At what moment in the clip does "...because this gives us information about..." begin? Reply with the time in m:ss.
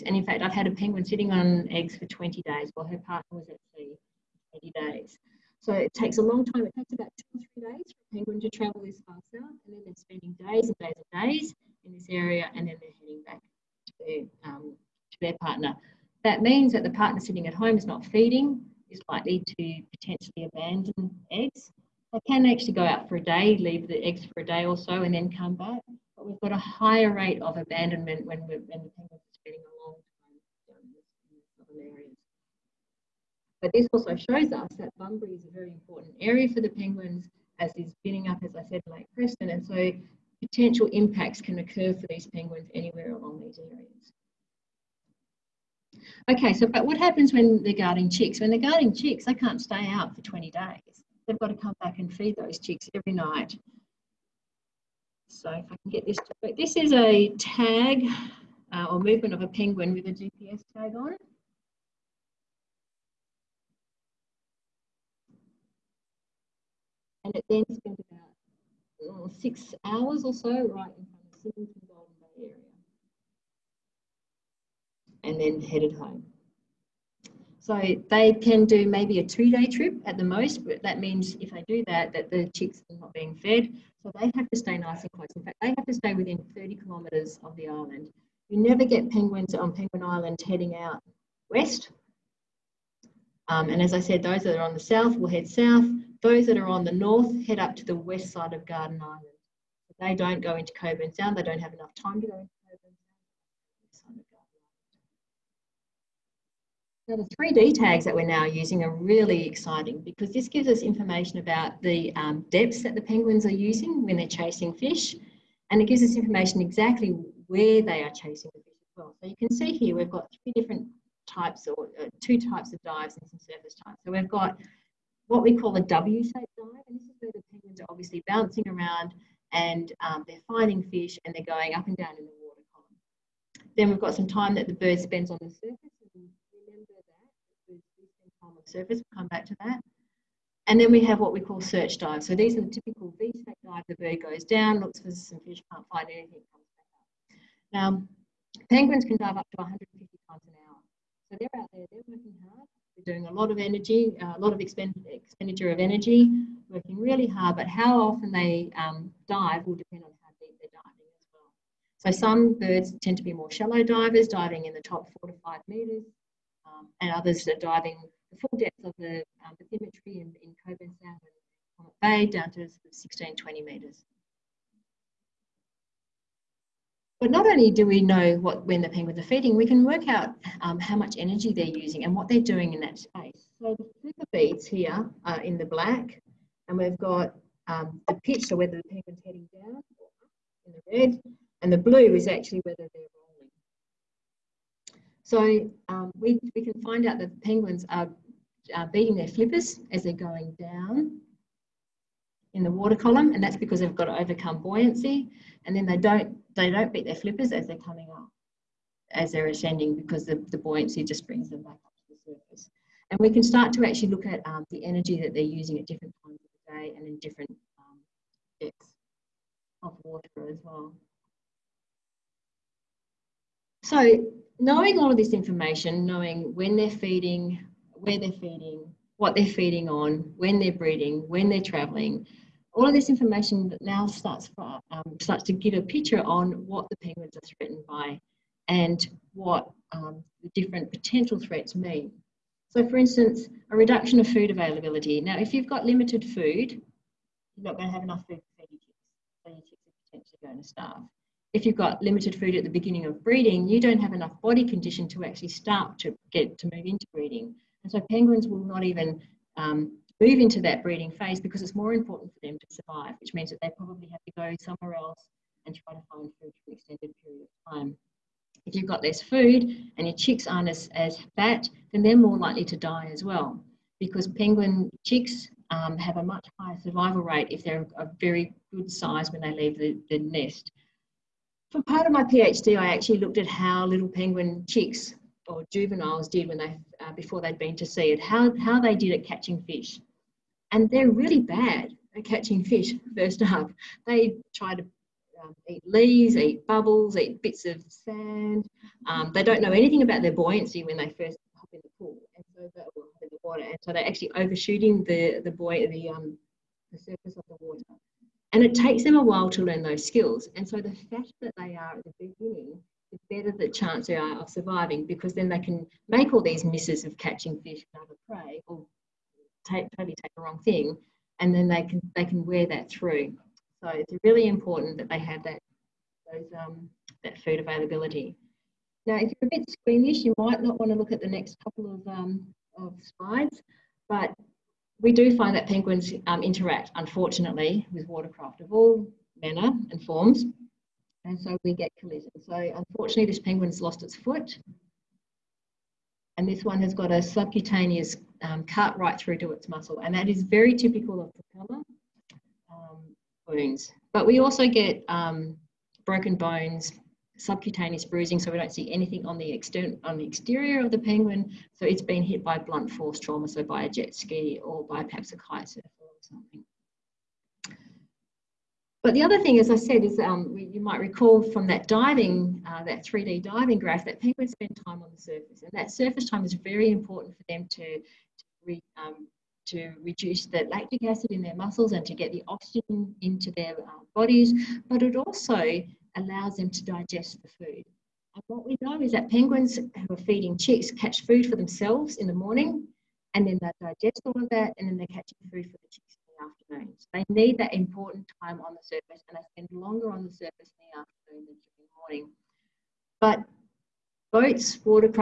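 1:50.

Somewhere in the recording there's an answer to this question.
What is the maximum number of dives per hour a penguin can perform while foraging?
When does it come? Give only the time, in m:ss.
2:29.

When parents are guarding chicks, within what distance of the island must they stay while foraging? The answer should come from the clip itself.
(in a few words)
30 kilometres.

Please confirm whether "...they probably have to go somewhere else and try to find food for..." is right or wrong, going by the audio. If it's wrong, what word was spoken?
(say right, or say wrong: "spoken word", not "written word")
right.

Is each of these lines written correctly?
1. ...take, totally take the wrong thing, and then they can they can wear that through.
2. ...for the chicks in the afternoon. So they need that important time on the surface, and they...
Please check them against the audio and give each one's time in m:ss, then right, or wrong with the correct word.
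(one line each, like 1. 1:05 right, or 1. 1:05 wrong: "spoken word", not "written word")
1. 5:19 right
2. 6:35 right.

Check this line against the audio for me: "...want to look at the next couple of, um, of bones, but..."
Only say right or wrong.
wrong.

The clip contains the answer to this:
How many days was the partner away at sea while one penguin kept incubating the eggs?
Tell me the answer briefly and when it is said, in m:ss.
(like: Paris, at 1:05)
80 days, at 0:04.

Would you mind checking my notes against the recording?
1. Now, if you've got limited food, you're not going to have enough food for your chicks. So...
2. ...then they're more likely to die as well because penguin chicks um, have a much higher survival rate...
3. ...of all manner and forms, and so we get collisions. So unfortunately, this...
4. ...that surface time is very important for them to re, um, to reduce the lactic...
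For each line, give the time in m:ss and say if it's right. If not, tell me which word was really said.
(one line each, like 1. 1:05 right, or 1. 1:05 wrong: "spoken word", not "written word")
1. 4:05 right
2. 4:31 right
3. 5:38 right
4. 6:15 right.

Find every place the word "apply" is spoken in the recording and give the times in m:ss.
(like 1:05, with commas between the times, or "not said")
not said.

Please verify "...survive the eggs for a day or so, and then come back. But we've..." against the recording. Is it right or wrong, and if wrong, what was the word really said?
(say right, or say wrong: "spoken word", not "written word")
wrong: "leave", not "survive".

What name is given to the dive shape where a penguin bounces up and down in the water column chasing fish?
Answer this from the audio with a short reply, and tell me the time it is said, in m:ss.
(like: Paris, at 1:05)
W-shaped dive, at 2:05.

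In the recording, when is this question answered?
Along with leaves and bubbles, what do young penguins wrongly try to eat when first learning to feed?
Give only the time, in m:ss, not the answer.
4:57.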